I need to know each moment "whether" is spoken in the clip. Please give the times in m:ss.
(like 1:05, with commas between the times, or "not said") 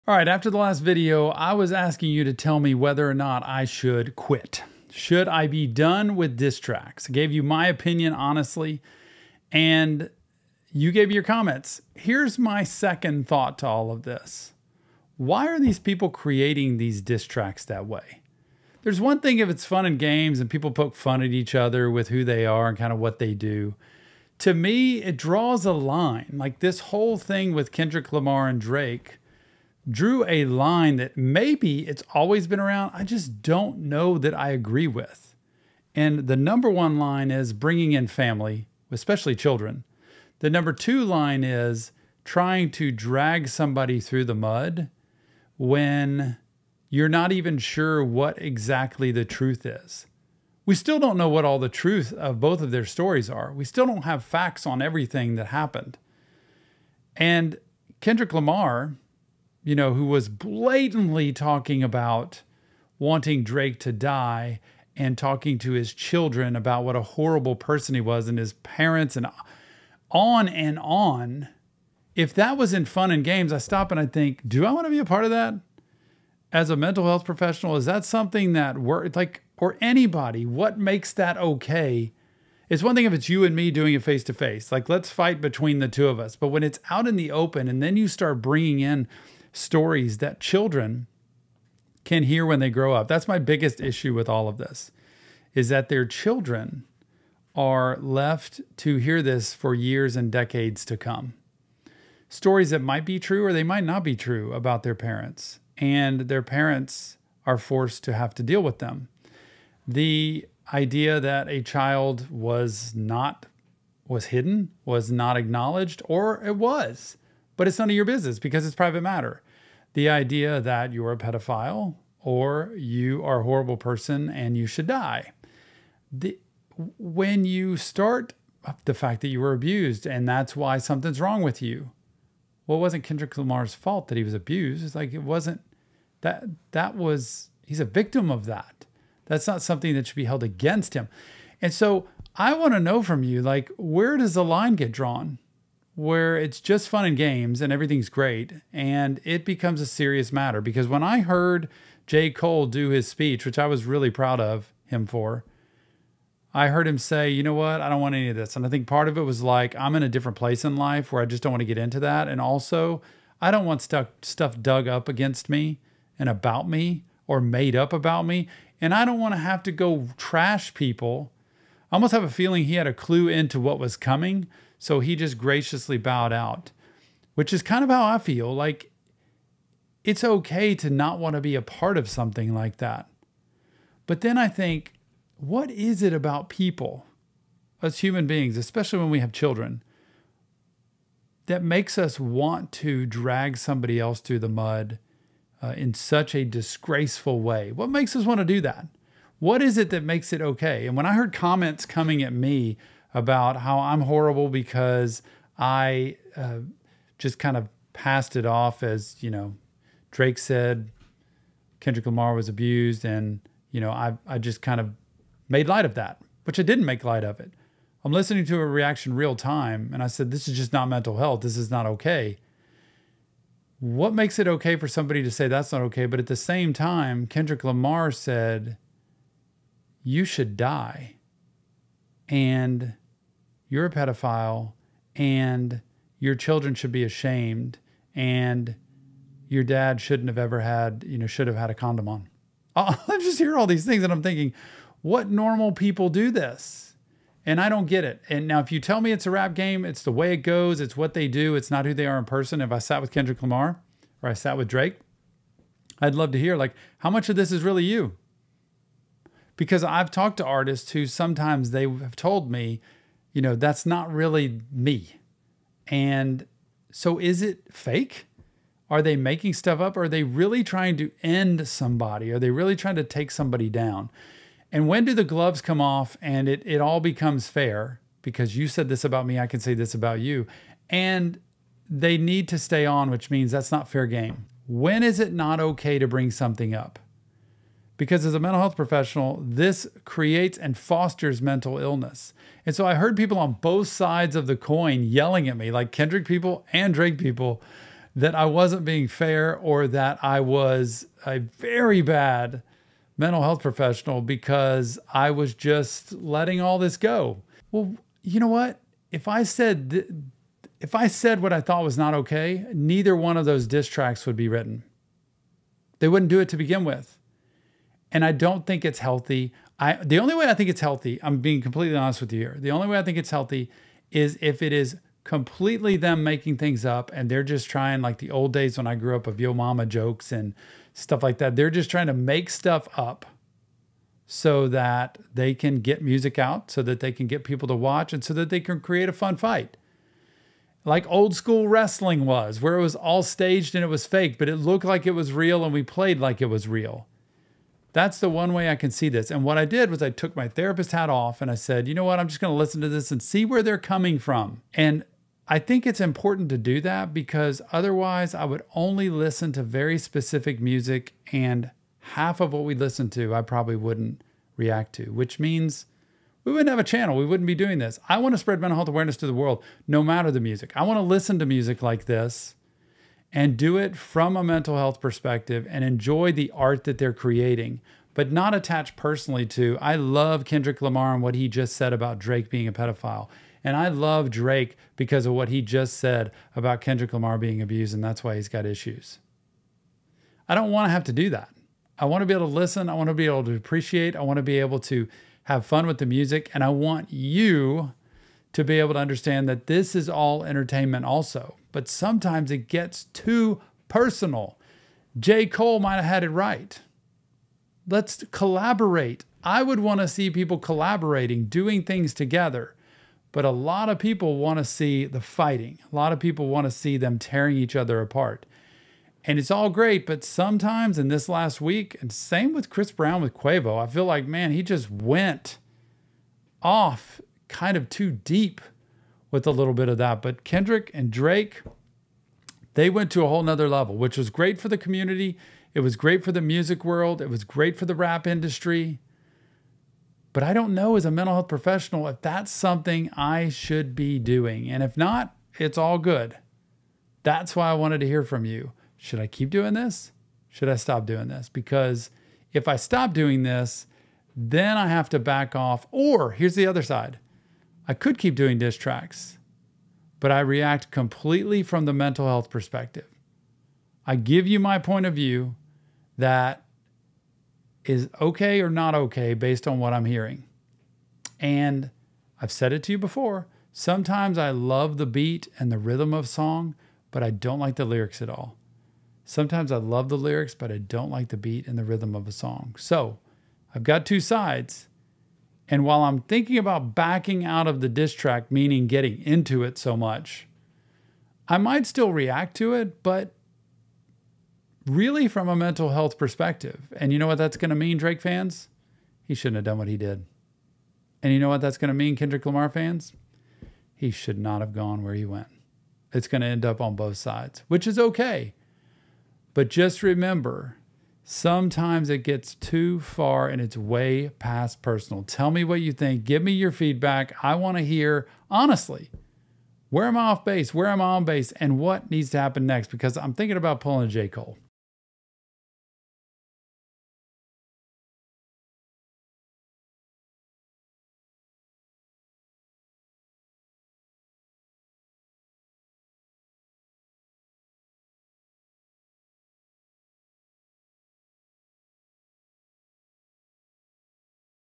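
0:02.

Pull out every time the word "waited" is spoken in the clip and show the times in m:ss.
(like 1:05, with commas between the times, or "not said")
not said.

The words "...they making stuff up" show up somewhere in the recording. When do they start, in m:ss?
4:29.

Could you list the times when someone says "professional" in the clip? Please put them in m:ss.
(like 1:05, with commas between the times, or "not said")
1:17, 4:48, 5:03, 7:21.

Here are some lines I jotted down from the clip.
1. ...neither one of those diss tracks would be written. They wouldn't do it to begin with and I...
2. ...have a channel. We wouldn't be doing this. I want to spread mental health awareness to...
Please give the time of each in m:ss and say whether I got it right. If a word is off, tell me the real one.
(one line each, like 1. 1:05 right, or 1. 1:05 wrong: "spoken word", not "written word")
1. 5:12 right
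2. 6:06 right.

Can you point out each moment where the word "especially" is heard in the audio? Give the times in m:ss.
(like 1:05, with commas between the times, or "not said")
0:38, 3:08.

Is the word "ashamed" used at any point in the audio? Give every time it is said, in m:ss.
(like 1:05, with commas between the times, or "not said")
3:57.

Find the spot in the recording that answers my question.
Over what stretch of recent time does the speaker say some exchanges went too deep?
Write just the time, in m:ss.
7:01.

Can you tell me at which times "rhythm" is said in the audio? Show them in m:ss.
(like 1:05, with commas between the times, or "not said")
7:55, 8:01.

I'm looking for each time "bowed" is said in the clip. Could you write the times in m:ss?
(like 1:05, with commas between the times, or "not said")
2:55.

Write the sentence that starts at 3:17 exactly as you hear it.
What makes us want to do that?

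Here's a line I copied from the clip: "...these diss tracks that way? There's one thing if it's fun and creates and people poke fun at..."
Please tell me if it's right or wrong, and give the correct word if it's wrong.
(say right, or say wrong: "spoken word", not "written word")
wrong: "games", not "creates".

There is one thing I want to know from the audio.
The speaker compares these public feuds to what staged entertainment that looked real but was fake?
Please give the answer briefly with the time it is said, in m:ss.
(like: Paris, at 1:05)
old school wrestling, at 5:41.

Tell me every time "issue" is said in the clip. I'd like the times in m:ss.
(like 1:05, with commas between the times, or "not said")
1:33, 6:28.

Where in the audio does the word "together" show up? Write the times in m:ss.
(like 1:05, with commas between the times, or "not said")
6:52.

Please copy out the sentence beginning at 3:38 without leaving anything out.
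I'm listening to a reaction real time.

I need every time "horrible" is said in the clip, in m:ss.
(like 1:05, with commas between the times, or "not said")
1:07, 2:03, 3:24.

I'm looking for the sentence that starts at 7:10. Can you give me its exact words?
But Kendrick and Drake, they went to a whole nother level, which was great for the community.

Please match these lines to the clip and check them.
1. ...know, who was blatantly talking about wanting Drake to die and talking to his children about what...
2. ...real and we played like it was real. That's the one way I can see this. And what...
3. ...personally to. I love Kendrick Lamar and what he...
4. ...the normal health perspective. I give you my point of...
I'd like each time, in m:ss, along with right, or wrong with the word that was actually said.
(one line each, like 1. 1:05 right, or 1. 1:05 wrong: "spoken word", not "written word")
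1. 0:59 right
2. 5:45 right
3. 6:18 right
4. 7:41 wrong: "mental", not "normal".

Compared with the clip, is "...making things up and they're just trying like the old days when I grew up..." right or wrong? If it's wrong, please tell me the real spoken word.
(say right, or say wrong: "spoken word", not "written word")
right.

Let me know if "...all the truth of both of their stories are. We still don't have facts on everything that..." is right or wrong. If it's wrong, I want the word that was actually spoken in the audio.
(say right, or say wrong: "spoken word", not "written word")
right.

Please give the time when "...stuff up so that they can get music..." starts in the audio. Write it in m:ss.
5:32.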